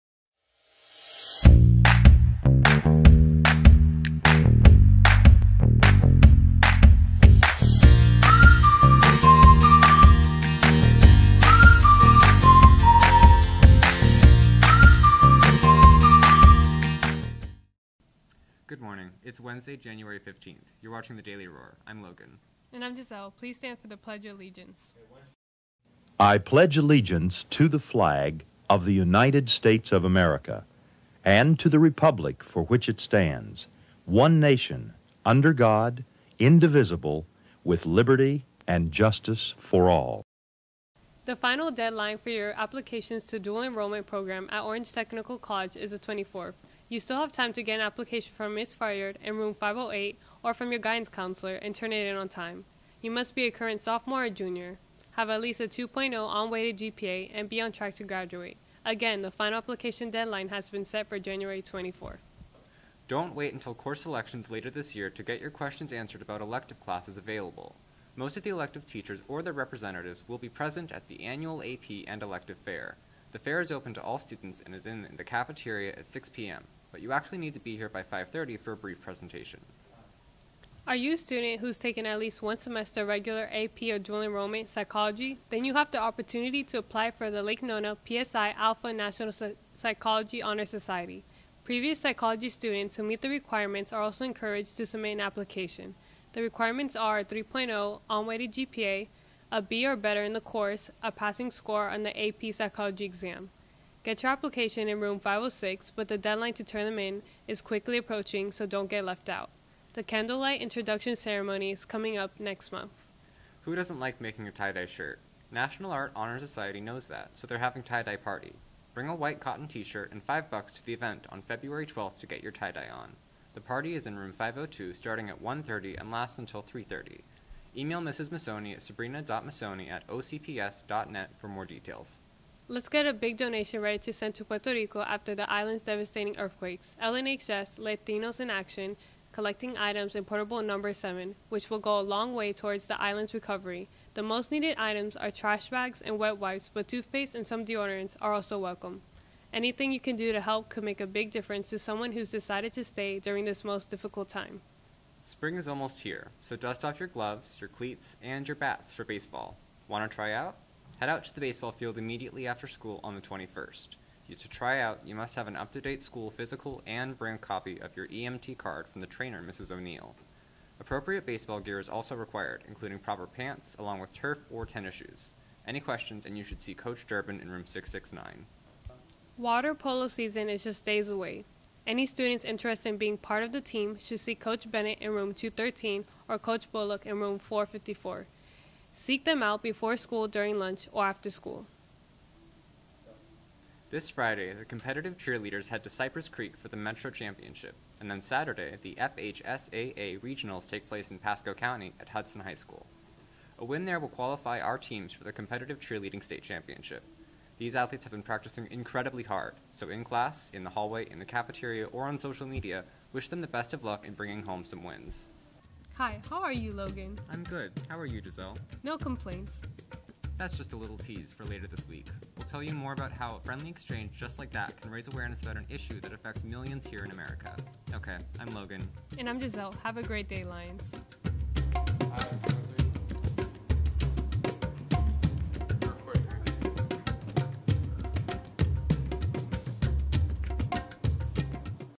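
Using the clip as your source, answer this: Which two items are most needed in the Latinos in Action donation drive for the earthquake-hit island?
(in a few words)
Trash bags and wet wipes.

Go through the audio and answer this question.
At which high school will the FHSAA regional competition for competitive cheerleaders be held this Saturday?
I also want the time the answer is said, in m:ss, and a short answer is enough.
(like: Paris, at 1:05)
Hudson High School, at 3:22.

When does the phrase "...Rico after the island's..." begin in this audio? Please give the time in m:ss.
2:14.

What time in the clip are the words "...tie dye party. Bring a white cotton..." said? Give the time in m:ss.
1:57.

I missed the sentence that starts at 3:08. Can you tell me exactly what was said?
Seek them out before school, during lunch, or after school.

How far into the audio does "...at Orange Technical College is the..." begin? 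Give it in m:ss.
0:44.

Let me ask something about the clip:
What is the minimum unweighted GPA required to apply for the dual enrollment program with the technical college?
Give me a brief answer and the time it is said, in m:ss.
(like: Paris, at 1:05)
2.0, at 0:55.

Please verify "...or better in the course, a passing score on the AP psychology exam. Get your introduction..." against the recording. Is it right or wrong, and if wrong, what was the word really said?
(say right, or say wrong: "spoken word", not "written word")
wrong: "application", not "introduction".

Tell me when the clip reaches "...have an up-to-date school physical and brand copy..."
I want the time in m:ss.
2:45.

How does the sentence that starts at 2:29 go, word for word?
Anything you can do to help could make a big difference to someone who's decided to stay during this most difficult time.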